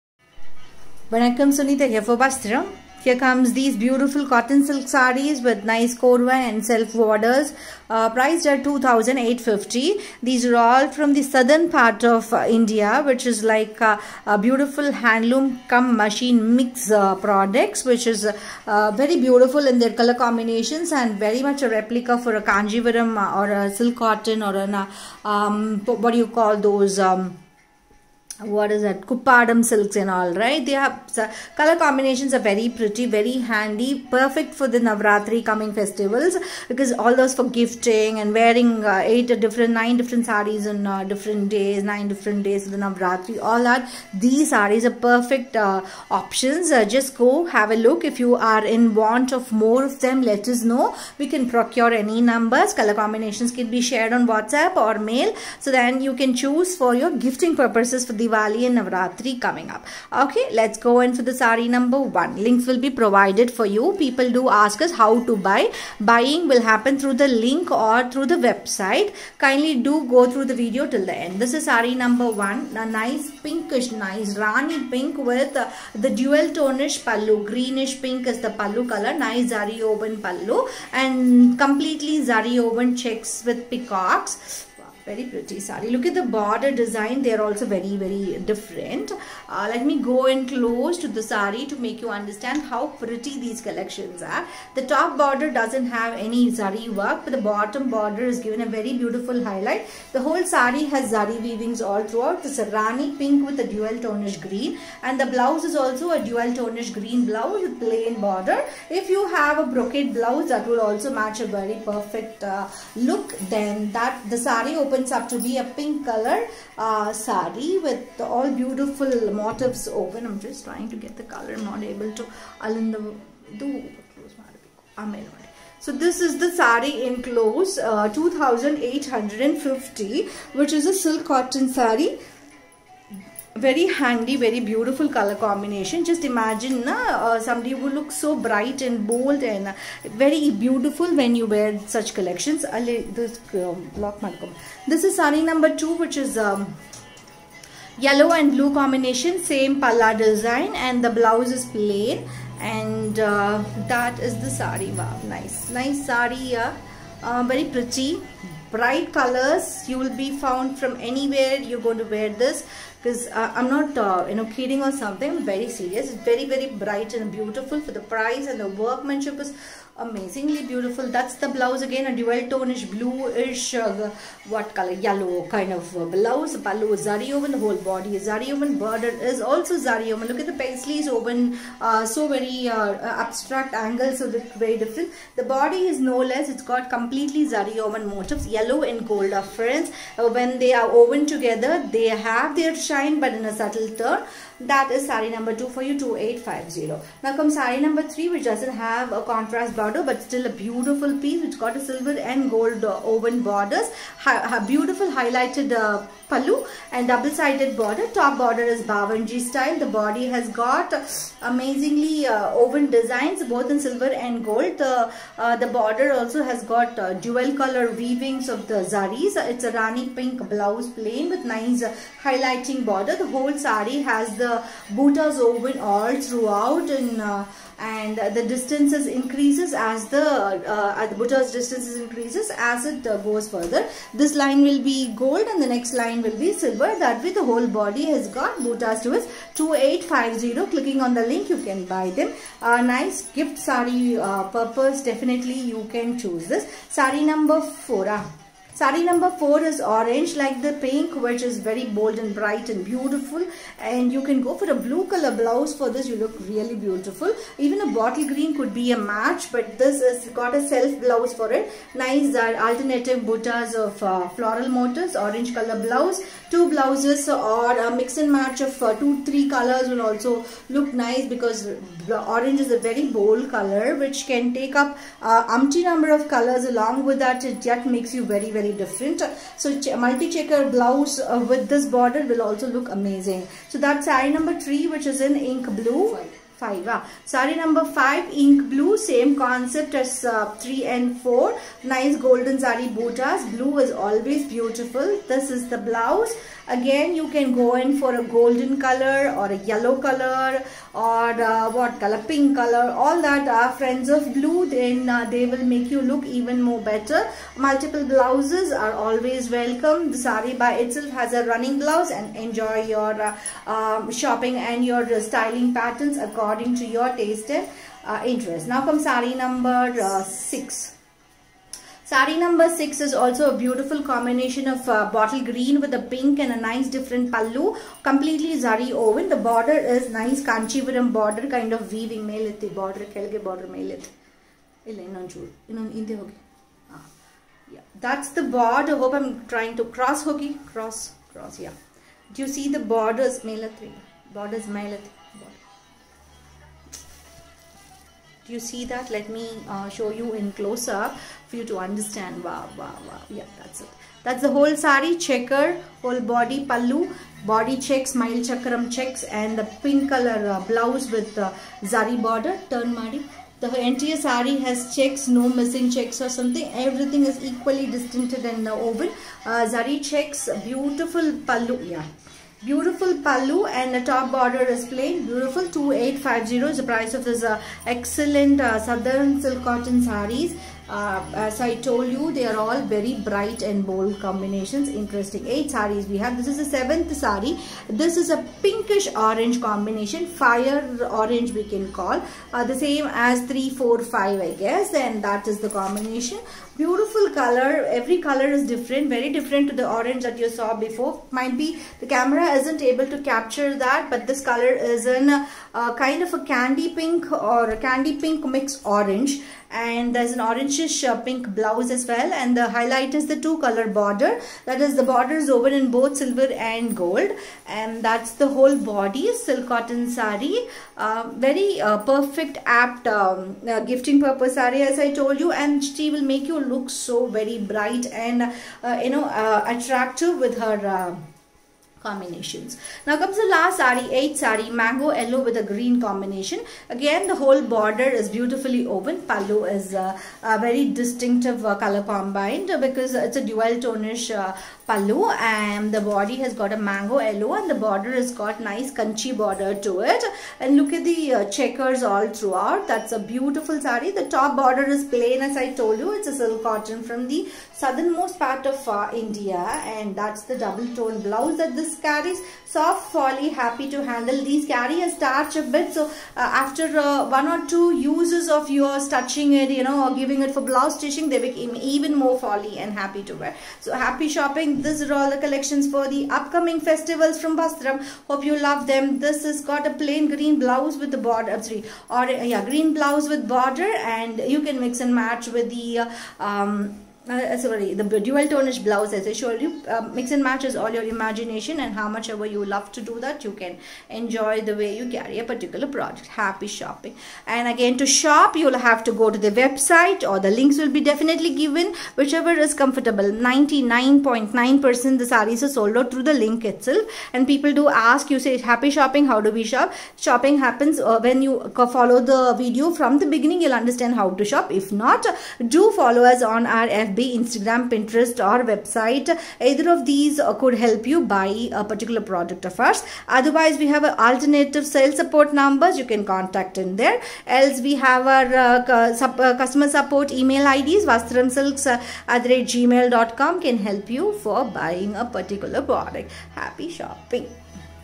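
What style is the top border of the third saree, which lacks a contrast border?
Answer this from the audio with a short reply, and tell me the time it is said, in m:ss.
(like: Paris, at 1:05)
Bavanji style, at 3:28.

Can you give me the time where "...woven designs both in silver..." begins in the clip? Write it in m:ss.
3:32.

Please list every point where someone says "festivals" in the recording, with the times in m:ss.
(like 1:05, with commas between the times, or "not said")
0:35, 7:56.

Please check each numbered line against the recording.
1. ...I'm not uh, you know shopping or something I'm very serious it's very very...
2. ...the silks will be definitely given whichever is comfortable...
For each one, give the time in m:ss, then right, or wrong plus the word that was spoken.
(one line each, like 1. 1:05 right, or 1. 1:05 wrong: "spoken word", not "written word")
1. 2:43 wrong: "kidding", not "shopping"
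2. 8:20 wrong: "links", not "silks".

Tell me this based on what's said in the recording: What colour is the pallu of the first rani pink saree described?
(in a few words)
Greenish pink.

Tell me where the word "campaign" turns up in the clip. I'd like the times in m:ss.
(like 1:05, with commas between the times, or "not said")
not said.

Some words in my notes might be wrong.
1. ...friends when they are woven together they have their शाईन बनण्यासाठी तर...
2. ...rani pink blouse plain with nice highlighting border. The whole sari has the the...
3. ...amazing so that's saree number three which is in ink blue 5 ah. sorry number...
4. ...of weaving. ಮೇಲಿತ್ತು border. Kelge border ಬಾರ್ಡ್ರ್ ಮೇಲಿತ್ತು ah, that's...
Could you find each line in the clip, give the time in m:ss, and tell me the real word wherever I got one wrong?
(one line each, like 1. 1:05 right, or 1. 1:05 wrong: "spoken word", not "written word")
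1. 3:09 right
2. 3:39 right
3. 4:42 right
4. 5:31 right.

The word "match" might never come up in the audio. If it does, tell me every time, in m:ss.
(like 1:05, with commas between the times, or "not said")
1:51, 4:18, 4:28, 8:05, 8:10.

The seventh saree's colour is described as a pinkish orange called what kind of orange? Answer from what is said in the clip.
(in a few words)
Fire orange.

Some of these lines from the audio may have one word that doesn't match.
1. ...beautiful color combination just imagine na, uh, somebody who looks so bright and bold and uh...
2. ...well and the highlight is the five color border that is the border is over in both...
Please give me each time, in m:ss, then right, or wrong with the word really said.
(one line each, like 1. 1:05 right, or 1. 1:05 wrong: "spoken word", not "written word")
1. 2:14 right
2. 6:52 wrong: "two", not "five".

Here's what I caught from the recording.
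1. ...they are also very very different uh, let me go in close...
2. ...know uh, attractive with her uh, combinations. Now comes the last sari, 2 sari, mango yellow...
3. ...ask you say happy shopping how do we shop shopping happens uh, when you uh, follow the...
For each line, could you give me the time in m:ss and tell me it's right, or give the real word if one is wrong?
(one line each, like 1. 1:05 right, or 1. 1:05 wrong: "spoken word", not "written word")
1. 1:27 right
2. 7:09 wrong: "8", not "2"
3. 8:27 right.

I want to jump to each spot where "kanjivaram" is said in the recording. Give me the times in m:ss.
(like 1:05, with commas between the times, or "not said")
0:22.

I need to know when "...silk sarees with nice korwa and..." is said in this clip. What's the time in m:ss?
0:04.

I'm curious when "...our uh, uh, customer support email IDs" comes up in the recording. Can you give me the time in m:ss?
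8:48.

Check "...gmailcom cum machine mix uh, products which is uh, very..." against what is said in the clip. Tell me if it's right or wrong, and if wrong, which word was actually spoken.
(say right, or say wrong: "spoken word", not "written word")
wrong: "handloom", not "gmailcom".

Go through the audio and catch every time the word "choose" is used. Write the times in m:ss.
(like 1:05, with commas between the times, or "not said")
0:56, 4:06.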